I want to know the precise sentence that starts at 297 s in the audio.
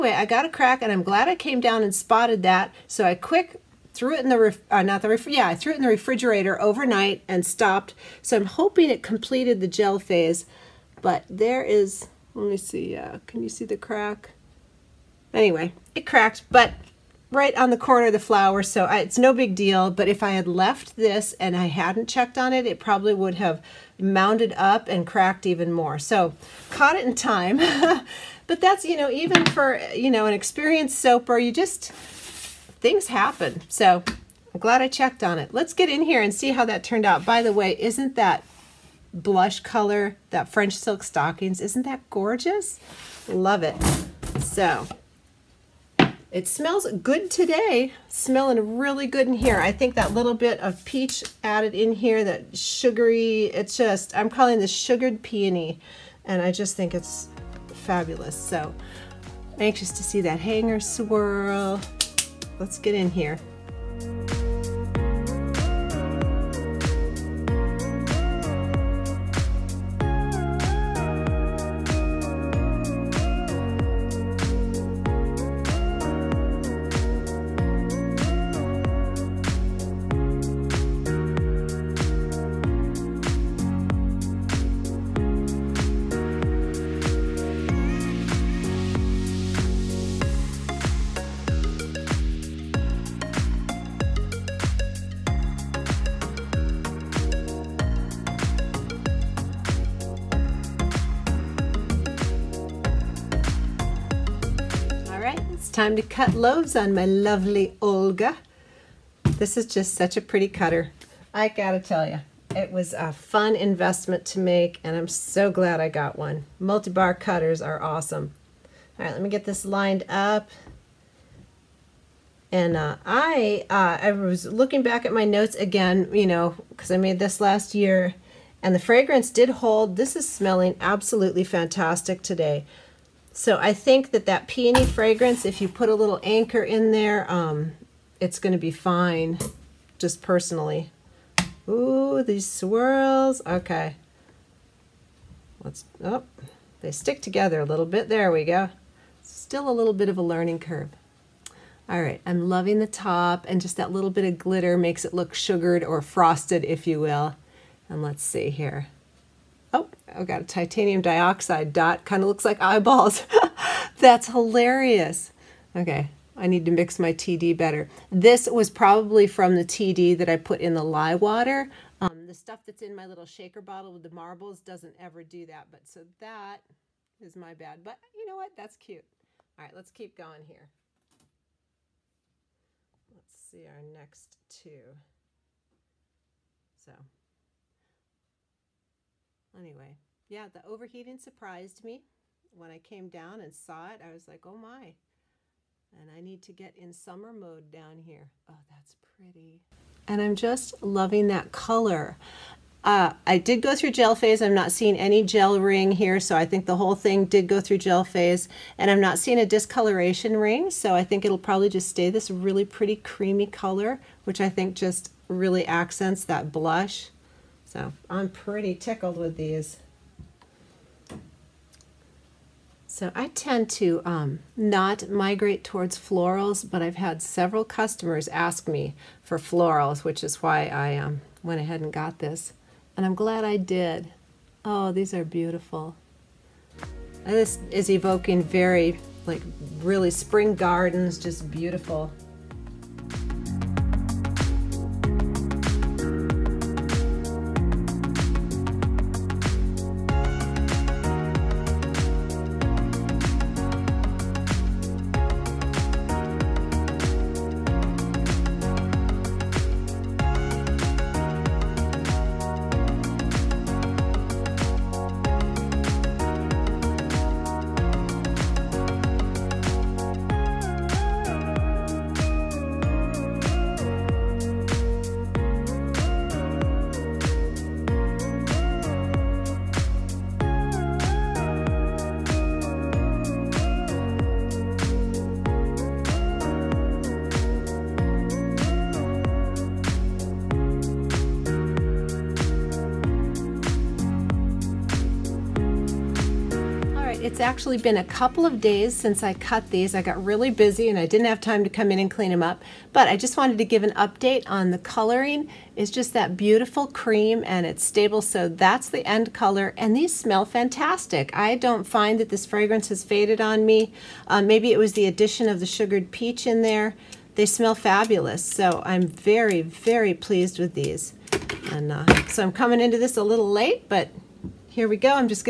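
It's actually been a couple of days since I cut these.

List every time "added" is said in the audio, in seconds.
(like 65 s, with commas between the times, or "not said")
51 s.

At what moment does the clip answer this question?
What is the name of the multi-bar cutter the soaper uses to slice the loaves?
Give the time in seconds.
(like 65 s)
107 s.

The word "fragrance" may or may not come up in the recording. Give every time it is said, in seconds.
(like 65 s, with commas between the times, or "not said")
128 s, 134 s, 312 s.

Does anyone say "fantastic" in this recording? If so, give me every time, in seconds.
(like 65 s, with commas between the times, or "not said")
131 s, 310 s.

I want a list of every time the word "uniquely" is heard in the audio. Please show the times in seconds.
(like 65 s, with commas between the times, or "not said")
not said.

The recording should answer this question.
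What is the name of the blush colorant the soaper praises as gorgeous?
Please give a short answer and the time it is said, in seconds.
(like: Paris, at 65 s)
French silk stockings, at 40 s.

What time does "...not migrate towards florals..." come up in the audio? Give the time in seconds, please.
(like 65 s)
224 s.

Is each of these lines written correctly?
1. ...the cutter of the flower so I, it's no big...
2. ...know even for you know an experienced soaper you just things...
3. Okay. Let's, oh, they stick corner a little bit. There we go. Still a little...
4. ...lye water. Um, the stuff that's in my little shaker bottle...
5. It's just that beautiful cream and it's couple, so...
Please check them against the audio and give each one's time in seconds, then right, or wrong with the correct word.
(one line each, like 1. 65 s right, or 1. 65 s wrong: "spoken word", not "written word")
1. 17 s wrong: "corner", not "cutter"
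2. 28 s right
3. 143 s wrong: "together", not "corner"
4. 170 s right
5. 305 s wrong: "stable", not "couple".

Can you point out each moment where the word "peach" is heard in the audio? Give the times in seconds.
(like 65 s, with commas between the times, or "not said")
50 s, 316 s.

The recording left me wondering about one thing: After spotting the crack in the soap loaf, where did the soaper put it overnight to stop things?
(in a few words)
refrigerator.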